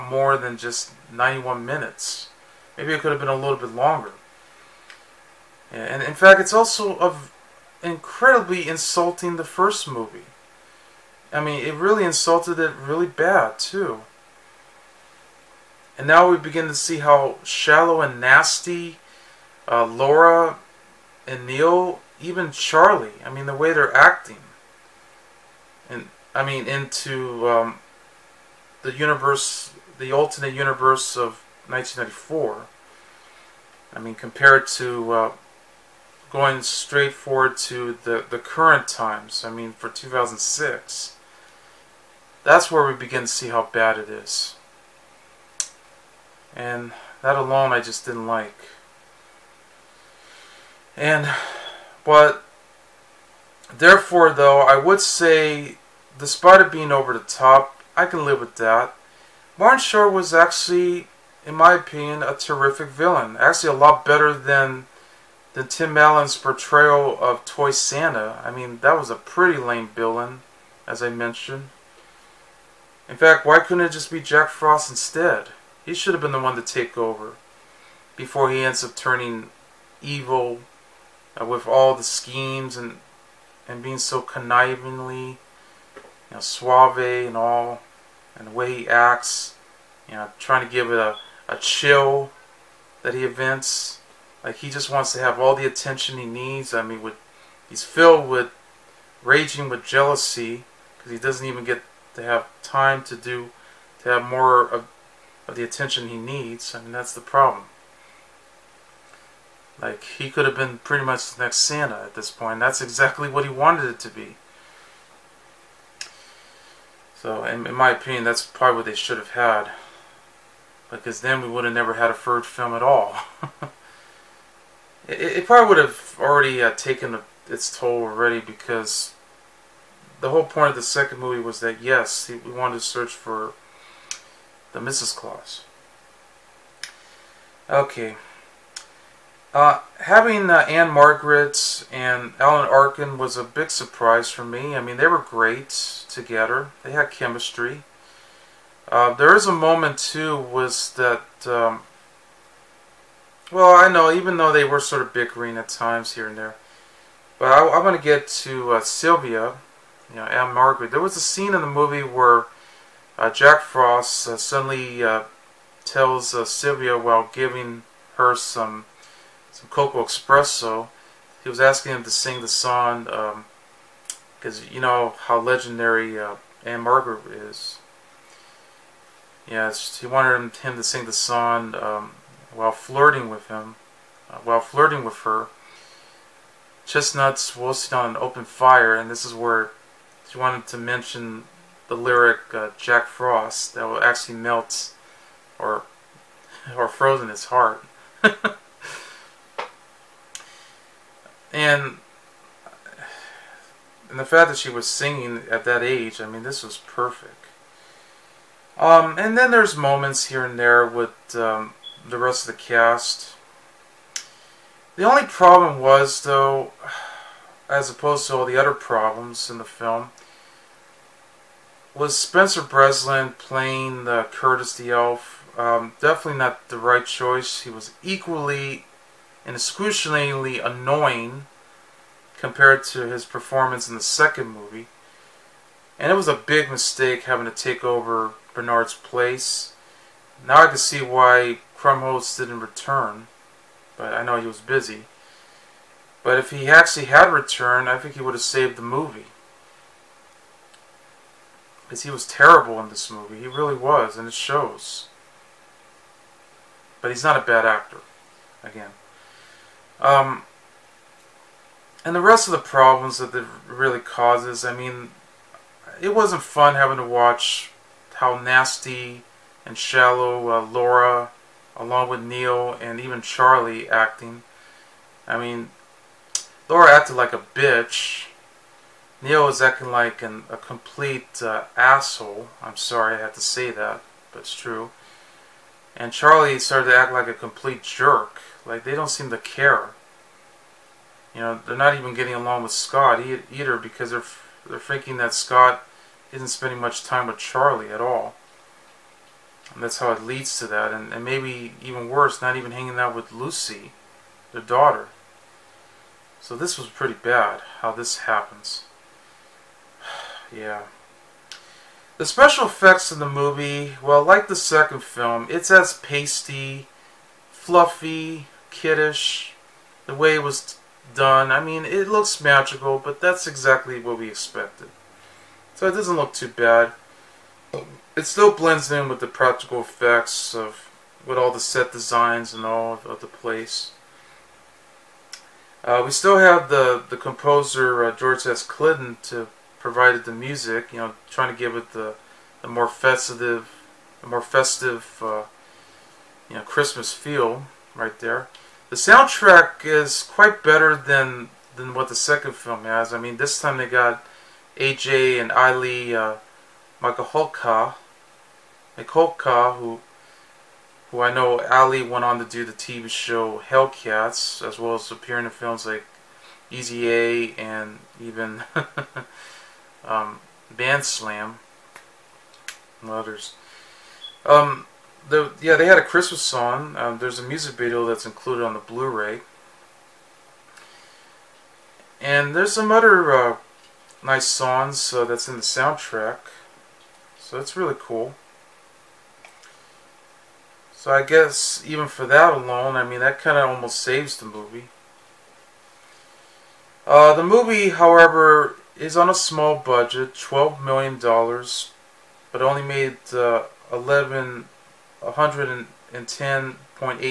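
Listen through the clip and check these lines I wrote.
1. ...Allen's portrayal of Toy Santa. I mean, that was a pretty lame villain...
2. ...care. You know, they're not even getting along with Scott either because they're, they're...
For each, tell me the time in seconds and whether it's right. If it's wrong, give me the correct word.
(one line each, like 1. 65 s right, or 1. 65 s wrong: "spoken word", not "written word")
1. 65 s right
2. 289 s right.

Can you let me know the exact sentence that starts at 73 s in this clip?
In fact, why couldn't it just be Jack Frost instead?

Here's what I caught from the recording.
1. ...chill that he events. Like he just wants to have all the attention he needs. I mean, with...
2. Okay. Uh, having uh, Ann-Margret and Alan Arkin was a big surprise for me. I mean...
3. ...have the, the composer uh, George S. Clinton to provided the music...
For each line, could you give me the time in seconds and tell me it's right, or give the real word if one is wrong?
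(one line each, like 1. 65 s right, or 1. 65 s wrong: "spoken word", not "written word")
1. 91 s right
2. 137 s right
3. 336 s right.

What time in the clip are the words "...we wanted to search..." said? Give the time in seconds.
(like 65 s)
132 s.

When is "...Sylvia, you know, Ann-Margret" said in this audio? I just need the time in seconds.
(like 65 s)
158 s.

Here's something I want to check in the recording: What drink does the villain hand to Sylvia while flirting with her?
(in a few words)
Coco Espresso.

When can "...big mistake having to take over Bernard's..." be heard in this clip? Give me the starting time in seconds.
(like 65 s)
236 s.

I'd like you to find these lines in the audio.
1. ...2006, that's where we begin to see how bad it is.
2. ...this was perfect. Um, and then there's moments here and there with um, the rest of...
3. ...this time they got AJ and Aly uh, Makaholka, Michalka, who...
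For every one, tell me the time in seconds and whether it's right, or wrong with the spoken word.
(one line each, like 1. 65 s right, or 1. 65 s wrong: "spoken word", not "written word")
1. 39 s right
2. 206 s right
3. 353 s right.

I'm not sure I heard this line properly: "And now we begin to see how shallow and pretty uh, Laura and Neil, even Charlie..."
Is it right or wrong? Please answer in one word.
wrong.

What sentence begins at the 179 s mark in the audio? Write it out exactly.
Yes, he wanted him, him, to sing the song um, while flirting with him, uh, while flirting with her.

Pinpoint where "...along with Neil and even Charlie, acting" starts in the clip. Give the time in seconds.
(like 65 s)
271 s.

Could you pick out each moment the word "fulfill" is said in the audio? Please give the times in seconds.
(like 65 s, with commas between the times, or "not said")
not said.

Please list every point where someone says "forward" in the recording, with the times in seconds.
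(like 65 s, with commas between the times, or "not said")
37 s.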